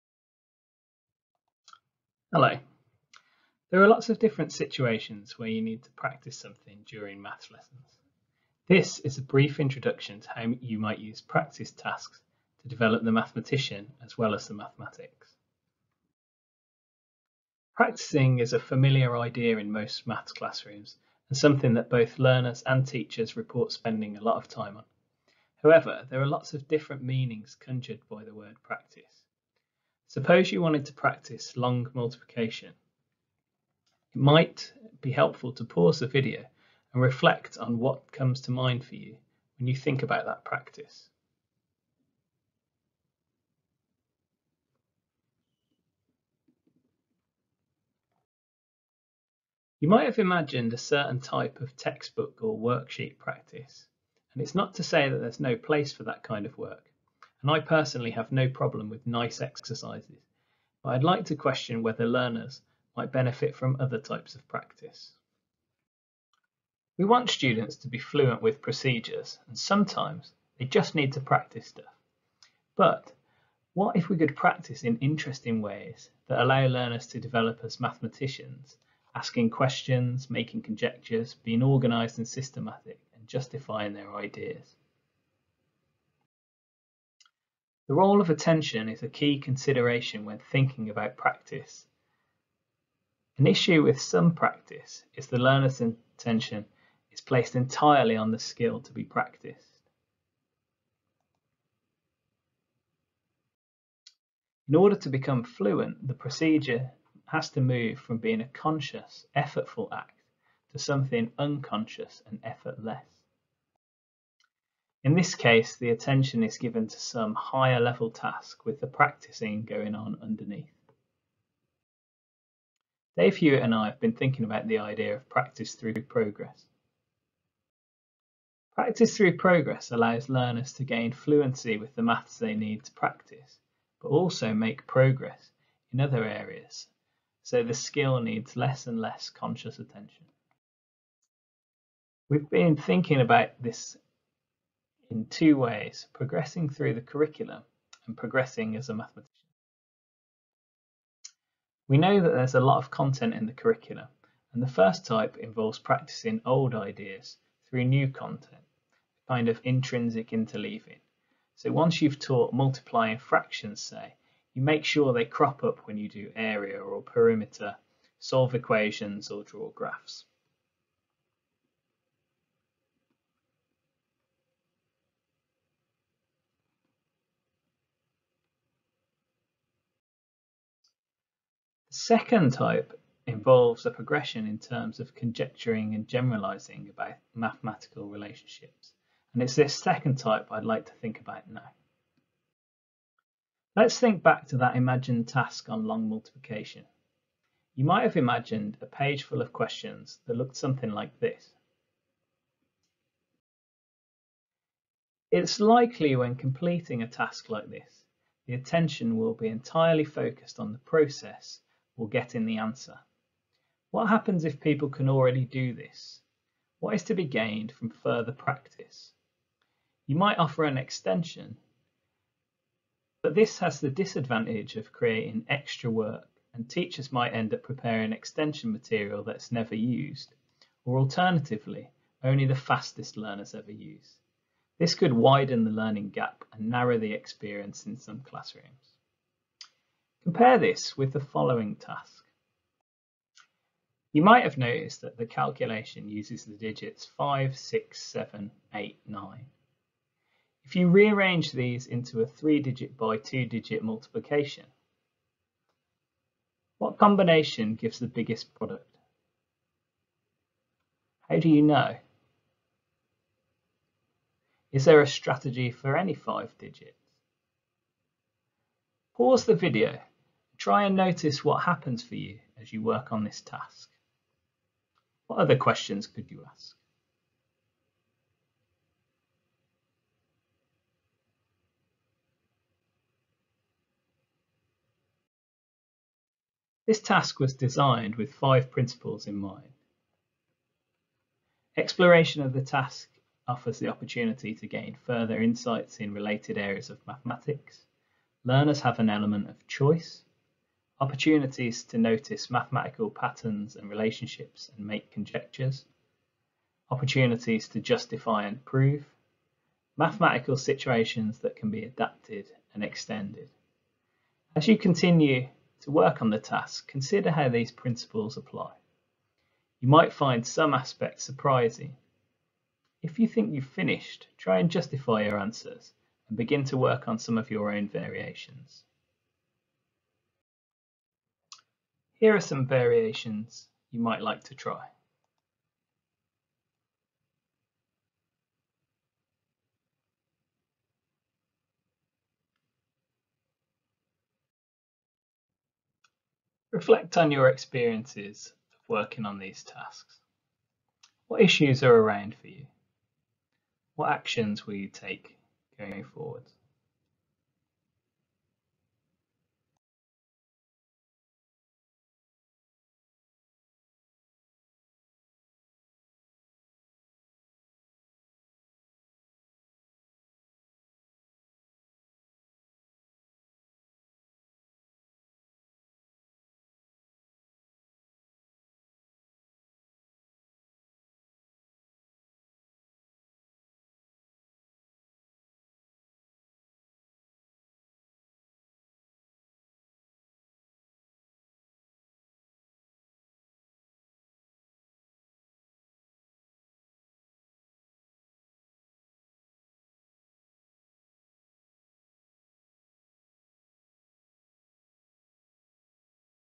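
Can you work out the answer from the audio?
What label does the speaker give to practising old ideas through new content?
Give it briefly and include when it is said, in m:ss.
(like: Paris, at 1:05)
intrinsic interleaving, at 2:39.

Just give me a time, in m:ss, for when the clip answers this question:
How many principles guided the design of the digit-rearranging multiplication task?
4:48.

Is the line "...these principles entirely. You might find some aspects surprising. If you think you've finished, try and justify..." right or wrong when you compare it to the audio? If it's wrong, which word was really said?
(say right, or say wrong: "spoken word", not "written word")
wrong: "apply", not "entirely".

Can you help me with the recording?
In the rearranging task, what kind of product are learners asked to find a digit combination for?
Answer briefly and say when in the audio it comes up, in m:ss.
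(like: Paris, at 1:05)
the biggest product, at 4:18.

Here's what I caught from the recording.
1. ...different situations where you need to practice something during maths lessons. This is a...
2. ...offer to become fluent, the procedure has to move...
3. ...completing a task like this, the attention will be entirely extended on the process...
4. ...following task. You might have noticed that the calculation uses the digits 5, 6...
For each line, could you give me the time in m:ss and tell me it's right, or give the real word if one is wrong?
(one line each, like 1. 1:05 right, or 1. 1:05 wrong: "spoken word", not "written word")
1. 0:04 right
2. 1:44 wrong: "order", not "offer"
3. 3:26 wrong: "focused", not "extended"
4. 4:01 right.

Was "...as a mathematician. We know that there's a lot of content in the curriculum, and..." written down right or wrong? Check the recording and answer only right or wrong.
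right.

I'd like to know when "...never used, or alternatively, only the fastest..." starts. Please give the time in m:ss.
3:49.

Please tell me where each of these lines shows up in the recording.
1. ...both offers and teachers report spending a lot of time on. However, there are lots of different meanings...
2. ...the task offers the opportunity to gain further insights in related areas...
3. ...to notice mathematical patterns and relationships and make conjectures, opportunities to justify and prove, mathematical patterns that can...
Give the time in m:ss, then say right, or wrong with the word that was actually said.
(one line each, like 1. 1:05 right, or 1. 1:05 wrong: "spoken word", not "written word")
1. 0:21 wrong: "learners", not "offers"
2. 4:52 right
3. 5:01 wrong: "situations", not "patterns".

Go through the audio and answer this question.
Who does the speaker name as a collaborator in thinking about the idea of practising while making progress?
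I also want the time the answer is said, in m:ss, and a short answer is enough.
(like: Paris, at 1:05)
Dave Hewitt, at 2:03.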